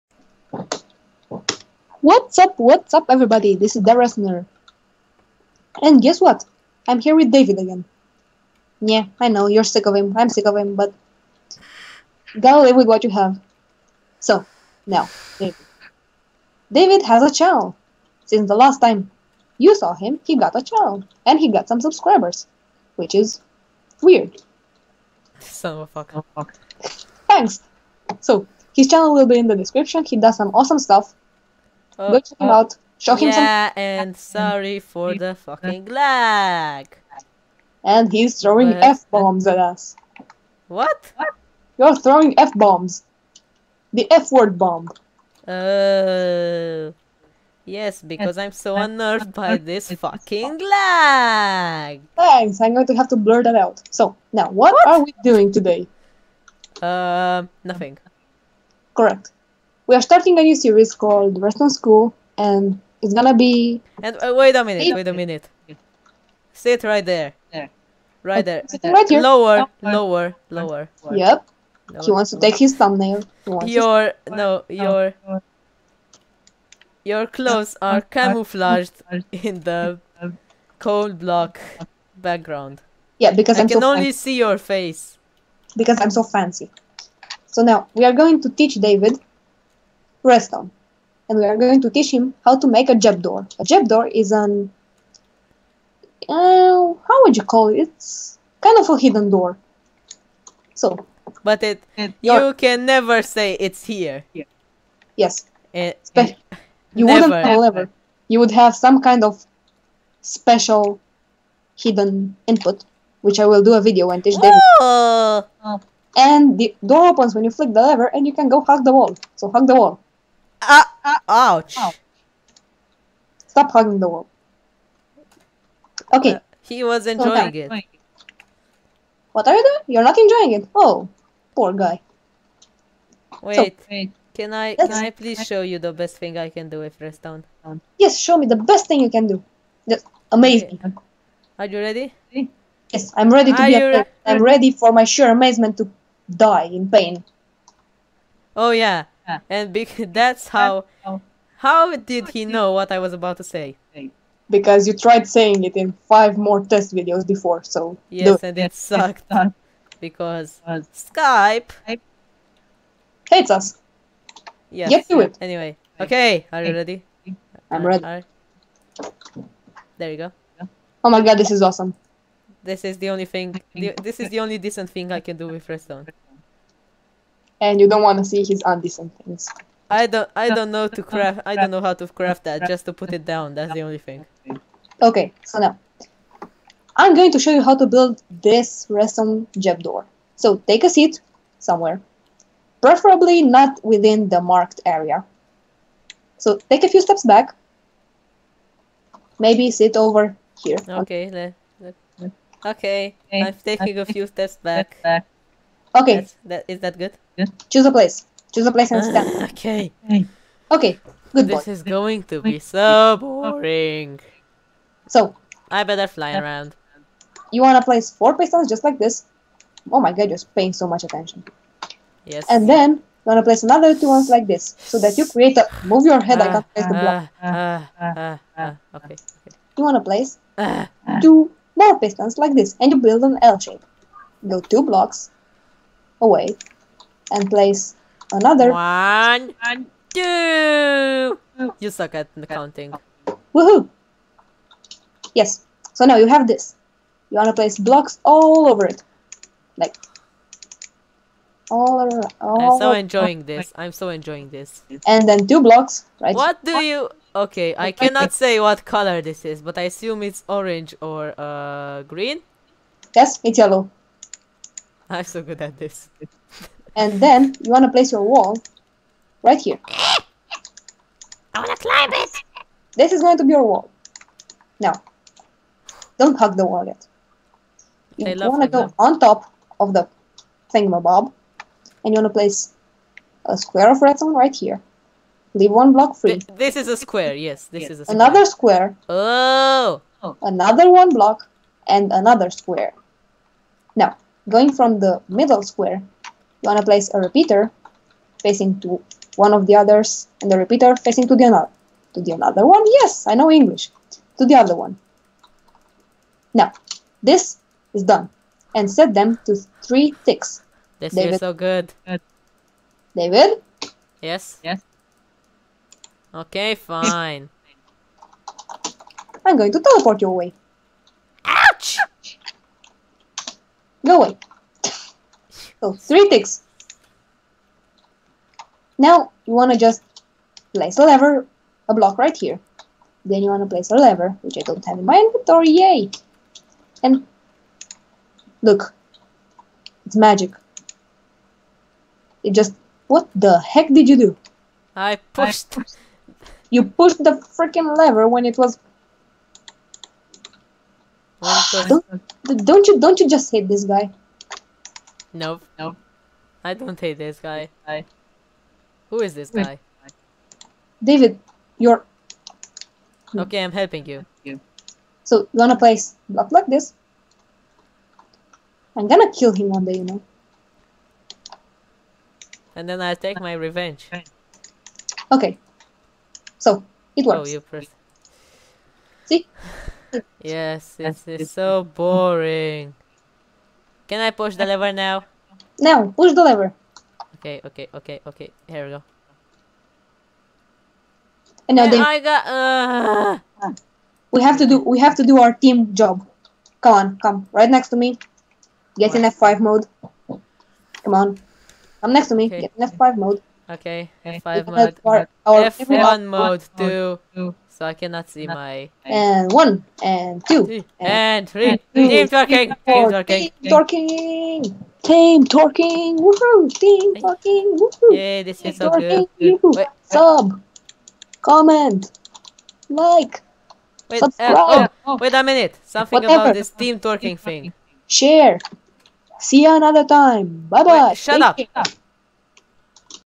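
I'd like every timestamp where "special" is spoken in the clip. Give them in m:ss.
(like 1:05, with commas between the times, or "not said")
1:50.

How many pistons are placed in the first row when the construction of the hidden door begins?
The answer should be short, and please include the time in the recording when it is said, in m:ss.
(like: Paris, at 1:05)
4, at 3:38.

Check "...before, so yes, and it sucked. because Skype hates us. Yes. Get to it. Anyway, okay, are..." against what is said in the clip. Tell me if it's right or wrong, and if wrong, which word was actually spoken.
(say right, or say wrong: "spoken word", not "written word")
right.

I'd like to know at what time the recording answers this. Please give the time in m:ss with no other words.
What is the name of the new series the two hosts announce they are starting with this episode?
1:01.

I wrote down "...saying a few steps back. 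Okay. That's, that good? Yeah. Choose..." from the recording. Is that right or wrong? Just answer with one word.
wrong.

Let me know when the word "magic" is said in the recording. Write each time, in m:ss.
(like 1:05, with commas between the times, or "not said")
5:40.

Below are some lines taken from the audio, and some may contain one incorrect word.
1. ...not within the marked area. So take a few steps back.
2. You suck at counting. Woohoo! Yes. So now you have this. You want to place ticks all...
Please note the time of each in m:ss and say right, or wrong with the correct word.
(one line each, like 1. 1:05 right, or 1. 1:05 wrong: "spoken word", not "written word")
1. 3:13 right
2. 4:01 wrong: "blocks", not "ticks".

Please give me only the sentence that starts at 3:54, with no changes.
Go two blocks, away and place another.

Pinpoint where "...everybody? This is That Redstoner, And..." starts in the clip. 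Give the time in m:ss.
0:03.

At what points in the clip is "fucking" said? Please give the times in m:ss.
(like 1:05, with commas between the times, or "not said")
0:35, 0:49.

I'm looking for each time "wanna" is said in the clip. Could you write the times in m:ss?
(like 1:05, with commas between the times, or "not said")
3:37, 3:43, 3:49, 6:05.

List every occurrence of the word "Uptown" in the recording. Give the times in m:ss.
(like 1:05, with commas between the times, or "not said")
not said.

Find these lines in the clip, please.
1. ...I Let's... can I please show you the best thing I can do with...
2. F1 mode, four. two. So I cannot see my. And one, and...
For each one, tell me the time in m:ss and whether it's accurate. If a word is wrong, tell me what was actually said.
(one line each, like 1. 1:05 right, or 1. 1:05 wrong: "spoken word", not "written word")
1. 2:14 right
2. 6:45 wrong: "two", not "four".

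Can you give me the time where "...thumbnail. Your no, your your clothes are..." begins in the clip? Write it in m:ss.
1:12.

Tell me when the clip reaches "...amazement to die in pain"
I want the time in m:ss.
2:25.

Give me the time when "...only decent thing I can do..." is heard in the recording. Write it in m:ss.
2:54.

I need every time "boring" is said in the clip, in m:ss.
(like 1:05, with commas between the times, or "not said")
3:33, 6:21.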